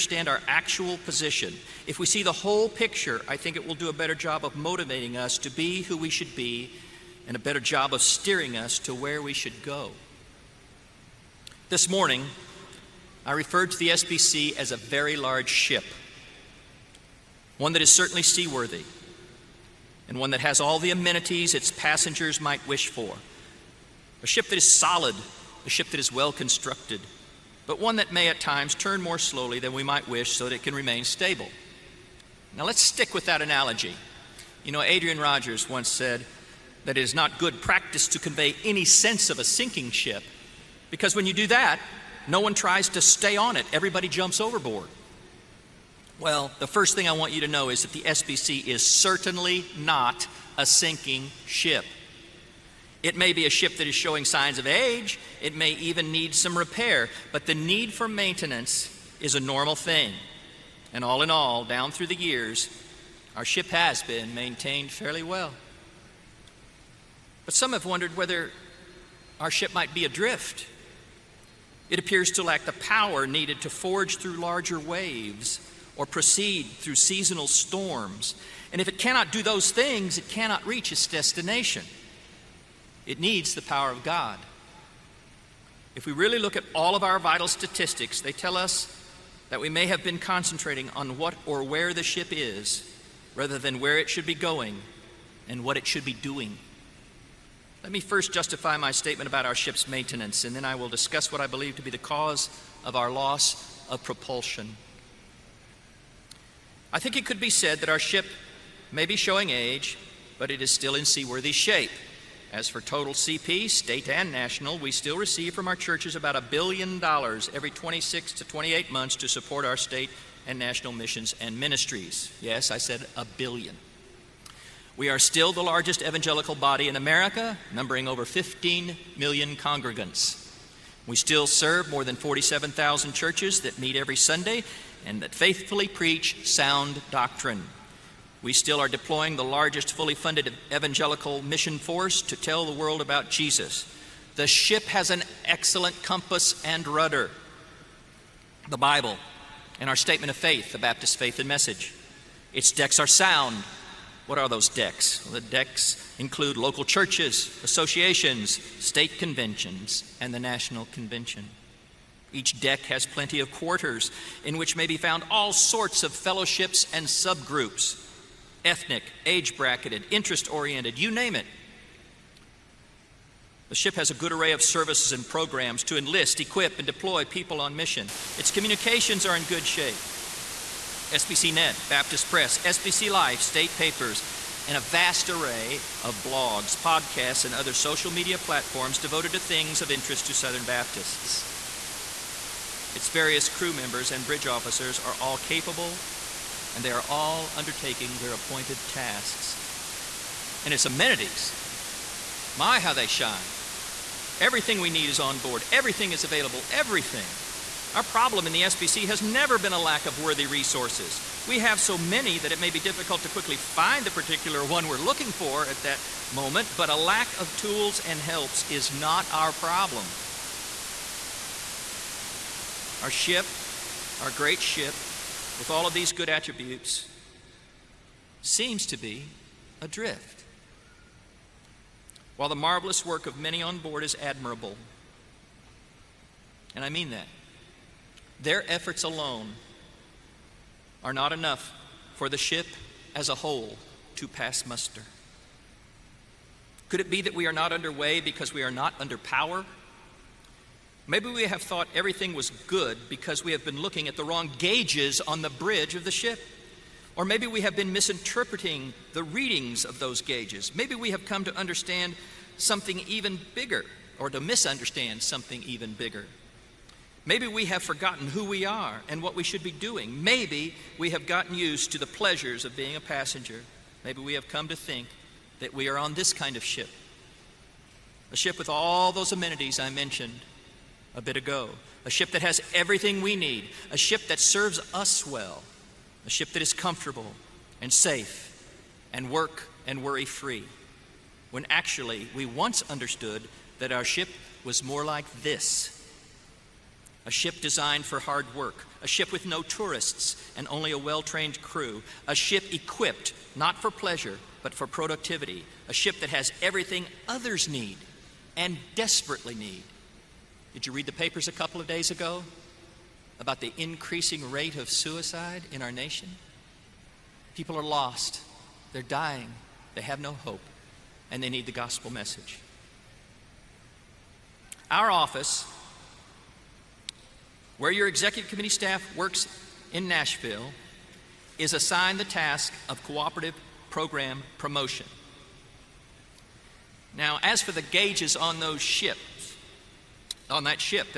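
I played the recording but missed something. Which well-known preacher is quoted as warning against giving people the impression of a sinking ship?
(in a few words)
Adrian Rogers.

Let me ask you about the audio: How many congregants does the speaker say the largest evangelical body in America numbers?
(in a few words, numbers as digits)
over 15 million.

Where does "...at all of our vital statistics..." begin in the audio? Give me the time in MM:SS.
01:26.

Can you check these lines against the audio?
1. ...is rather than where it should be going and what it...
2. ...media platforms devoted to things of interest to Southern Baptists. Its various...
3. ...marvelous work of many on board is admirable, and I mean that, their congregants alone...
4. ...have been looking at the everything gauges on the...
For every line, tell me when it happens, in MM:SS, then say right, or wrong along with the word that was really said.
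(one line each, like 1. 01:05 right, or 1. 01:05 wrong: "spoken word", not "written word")
1. 01:32 right
2. 03:08 right
3. 03:52 wrong: "efforts", not "congregants"
4. 04:13 wrong: "wrong", not "everything".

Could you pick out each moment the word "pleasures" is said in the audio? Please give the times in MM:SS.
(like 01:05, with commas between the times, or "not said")
04:32, 05:03.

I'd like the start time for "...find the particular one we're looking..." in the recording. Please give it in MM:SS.
03:33.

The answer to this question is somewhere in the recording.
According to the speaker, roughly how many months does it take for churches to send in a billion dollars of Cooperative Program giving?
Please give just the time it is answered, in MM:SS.
01:57.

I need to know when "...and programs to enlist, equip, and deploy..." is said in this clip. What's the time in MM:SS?
02:55.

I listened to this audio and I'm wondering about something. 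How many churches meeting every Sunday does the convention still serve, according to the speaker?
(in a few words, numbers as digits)
more than 47,000.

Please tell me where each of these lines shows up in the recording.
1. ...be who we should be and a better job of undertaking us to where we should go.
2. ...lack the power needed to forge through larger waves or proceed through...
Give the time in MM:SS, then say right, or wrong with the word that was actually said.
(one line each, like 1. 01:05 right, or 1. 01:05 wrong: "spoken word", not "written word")
1. 00:05 wrong: "steering", not "undertaking"
2. 01:12 right.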